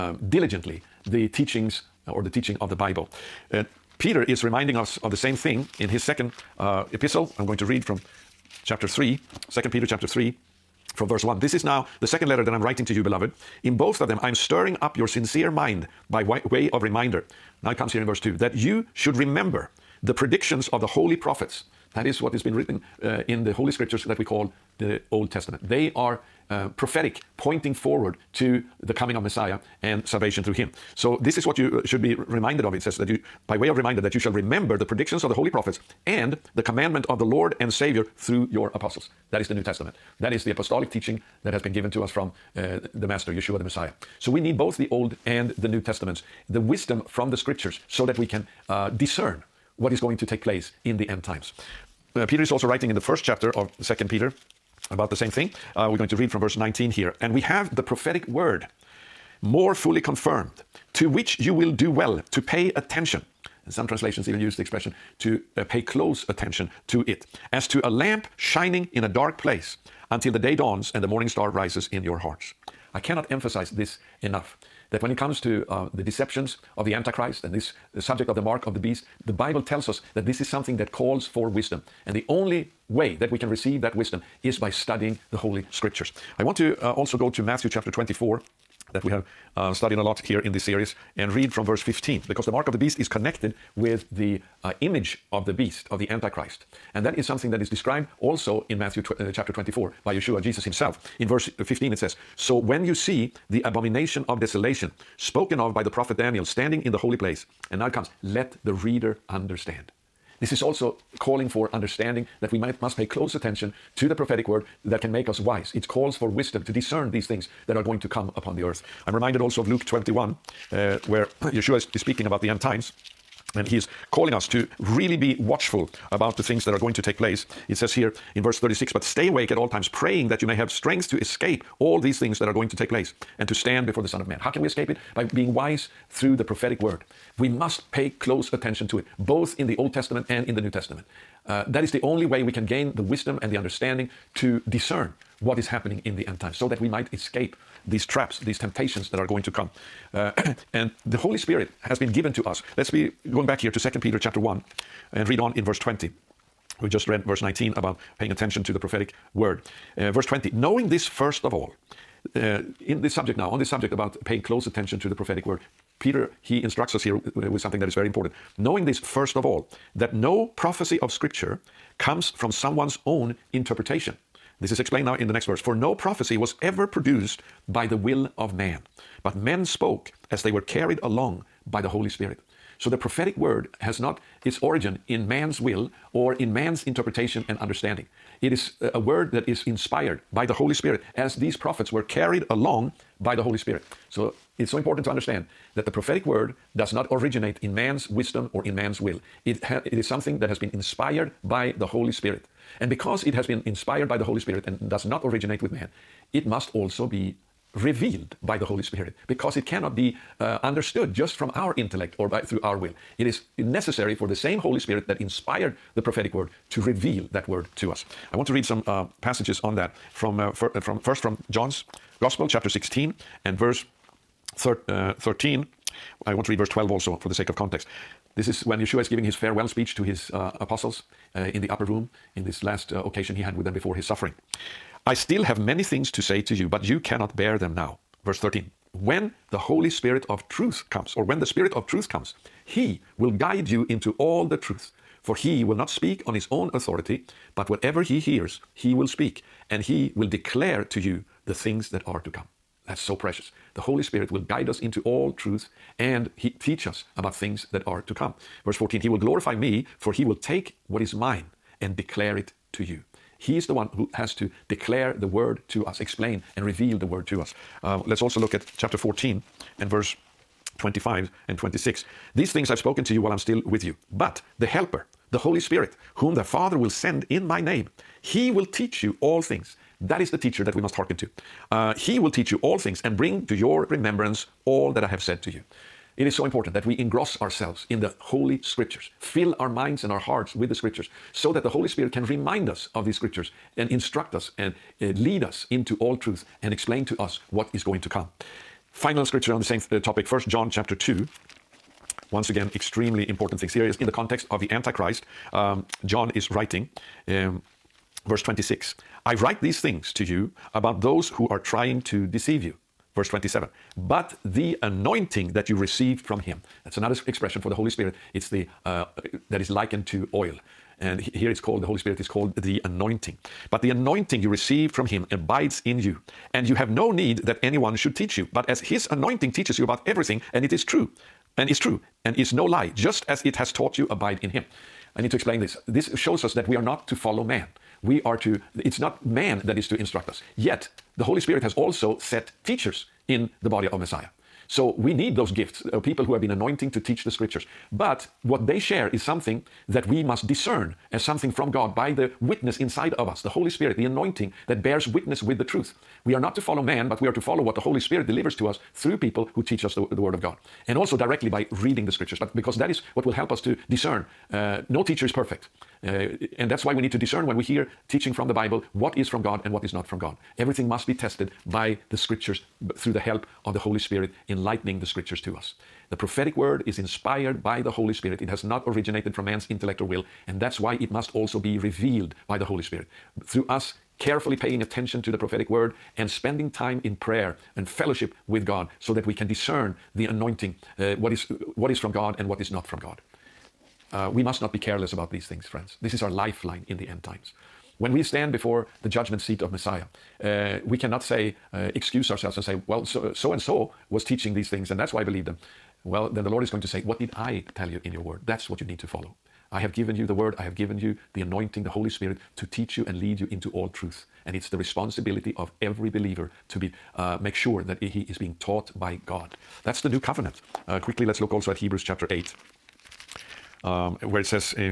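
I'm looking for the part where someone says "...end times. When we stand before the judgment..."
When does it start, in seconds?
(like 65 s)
397 s.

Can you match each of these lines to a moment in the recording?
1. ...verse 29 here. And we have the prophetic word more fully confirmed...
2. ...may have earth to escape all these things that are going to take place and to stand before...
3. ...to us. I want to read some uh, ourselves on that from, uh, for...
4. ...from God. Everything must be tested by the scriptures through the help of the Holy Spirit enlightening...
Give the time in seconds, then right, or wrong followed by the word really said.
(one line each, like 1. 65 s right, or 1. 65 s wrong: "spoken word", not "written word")
1. 56 s wrong: "19", not "29"
2. 130 s wrong: "strength", not "earth"
3. 217 s wrong: "passages", not "ourselves"
4. 370 s right.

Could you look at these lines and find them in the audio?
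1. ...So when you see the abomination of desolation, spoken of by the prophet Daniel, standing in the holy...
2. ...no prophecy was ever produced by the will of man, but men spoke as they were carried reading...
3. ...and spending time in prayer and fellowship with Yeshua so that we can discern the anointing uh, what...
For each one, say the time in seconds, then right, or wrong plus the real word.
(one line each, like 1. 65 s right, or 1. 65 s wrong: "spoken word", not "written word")
1. 102 s right
2. 175 s wrong: "along", not "reading"
3. 386 s wrong: "God", not "Yeshua".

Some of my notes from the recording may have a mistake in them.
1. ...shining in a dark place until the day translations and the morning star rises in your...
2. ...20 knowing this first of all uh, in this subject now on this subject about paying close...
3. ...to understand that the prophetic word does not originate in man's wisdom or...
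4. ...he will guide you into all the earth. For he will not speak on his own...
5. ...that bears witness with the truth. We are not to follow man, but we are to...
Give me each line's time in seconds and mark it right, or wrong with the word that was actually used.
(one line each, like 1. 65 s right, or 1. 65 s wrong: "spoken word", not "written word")
1. 68 s wrong: "dawns", not "translations"
2. 160 s right
3. 195 s right
4. 242 s wrong: "truth", not "earth"
5. 354 s right.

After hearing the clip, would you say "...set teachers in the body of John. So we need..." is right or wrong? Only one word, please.
wrong.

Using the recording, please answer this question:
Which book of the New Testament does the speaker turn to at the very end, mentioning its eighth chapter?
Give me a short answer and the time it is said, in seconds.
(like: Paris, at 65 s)
Hebrews, at 421 s.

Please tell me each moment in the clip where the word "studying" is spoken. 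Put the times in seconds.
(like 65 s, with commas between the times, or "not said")
84 s, 89 s.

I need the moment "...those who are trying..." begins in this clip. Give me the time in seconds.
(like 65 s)
311 s.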